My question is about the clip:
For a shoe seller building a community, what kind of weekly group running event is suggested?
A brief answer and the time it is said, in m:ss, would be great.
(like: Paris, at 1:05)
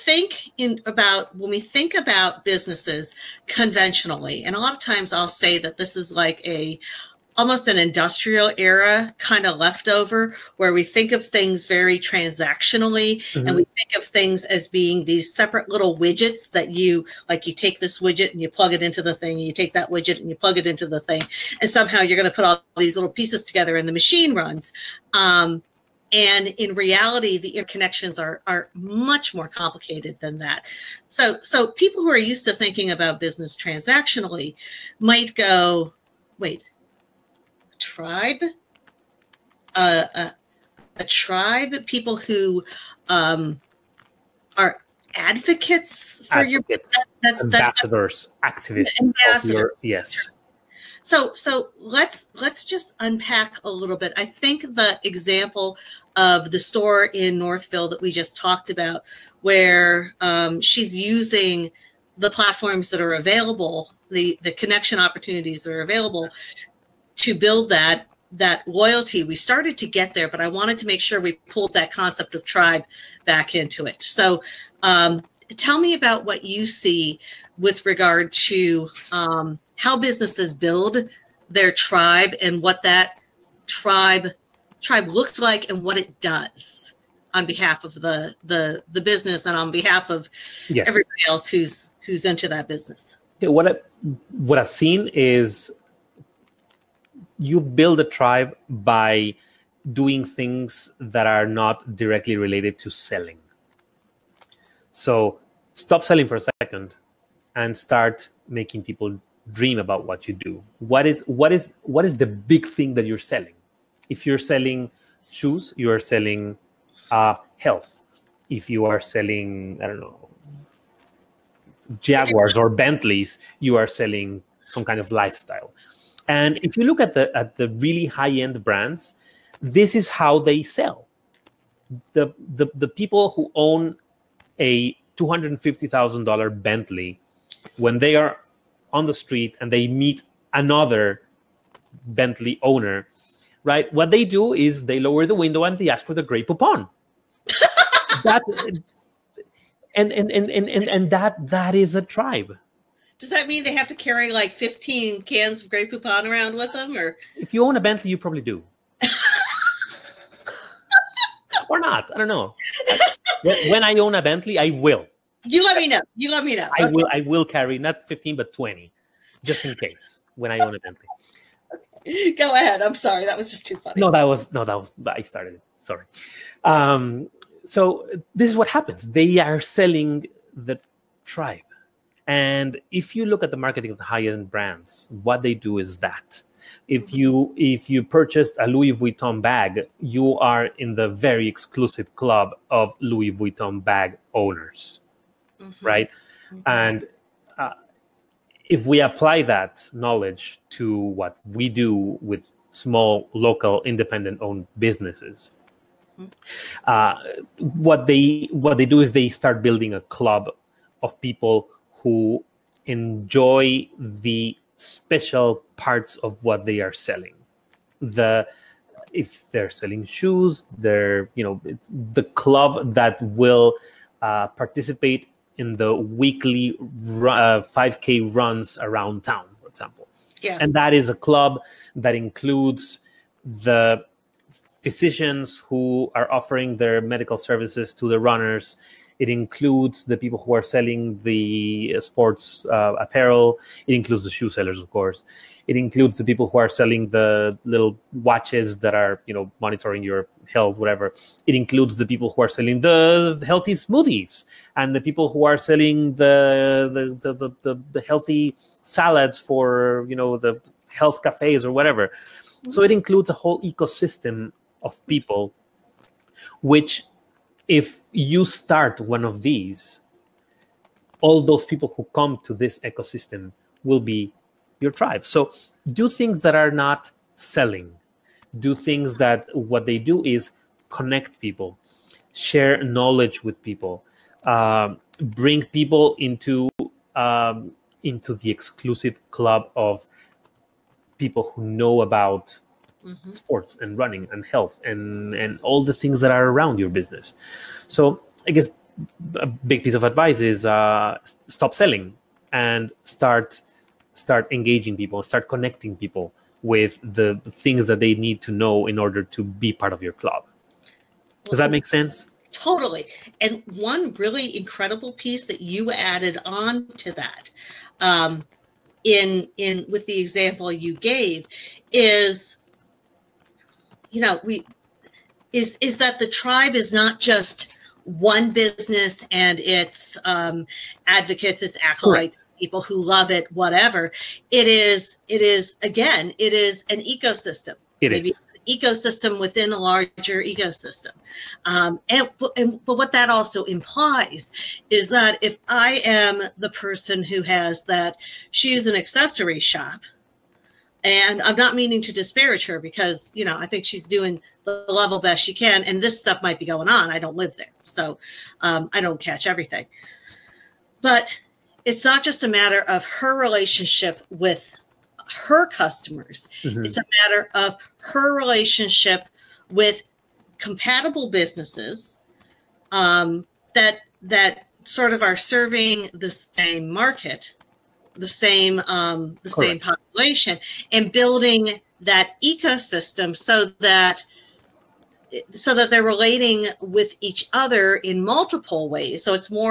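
5K runs, at 3:47.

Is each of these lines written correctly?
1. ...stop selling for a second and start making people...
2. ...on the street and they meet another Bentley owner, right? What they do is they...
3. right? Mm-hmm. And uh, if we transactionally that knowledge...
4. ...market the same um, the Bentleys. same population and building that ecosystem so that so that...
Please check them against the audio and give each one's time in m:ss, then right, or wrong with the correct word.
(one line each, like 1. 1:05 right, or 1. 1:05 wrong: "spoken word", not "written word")
1. 1:45 right
2. 2:18 right
3. 3:15 wrong: "apply", not "transactionally"
4. 6:16 wrong: "Correct", not "Bentleys".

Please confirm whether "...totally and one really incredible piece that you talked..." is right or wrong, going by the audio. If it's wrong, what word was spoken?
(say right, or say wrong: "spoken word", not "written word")
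wrong: "added", not "talked".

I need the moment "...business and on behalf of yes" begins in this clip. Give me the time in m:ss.
1:28.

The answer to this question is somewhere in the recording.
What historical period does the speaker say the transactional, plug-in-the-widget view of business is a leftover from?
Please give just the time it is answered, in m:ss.
0:07.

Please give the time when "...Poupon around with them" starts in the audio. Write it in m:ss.
2:35.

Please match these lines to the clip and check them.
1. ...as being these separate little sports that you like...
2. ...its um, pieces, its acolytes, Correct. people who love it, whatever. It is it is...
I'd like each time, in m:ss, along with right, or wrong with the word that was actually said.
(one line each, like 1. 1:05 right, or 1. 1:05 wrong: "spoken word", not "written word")
1. 0:14 wrong: "widgets", not "sports"
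2. 5:29 wrong: "advocates", not "pieces".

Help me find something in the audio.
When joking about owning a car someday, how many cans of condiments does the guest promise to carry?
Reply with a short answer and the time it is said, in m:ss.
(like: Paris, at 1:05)
20, at 2:48.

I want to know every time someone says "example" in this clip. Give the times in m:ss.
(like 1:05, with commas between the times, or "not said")
0:55, 3:49, 5:20.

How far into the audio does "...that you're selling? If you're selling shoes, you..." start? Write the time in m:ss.
1:52.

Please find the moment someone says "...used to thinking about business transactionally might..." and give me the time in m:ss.
0:32.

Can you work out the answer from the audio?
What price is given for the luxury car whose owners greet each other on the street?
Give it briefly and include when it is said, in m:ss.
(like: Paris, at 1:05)
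$250,000, at 2:15.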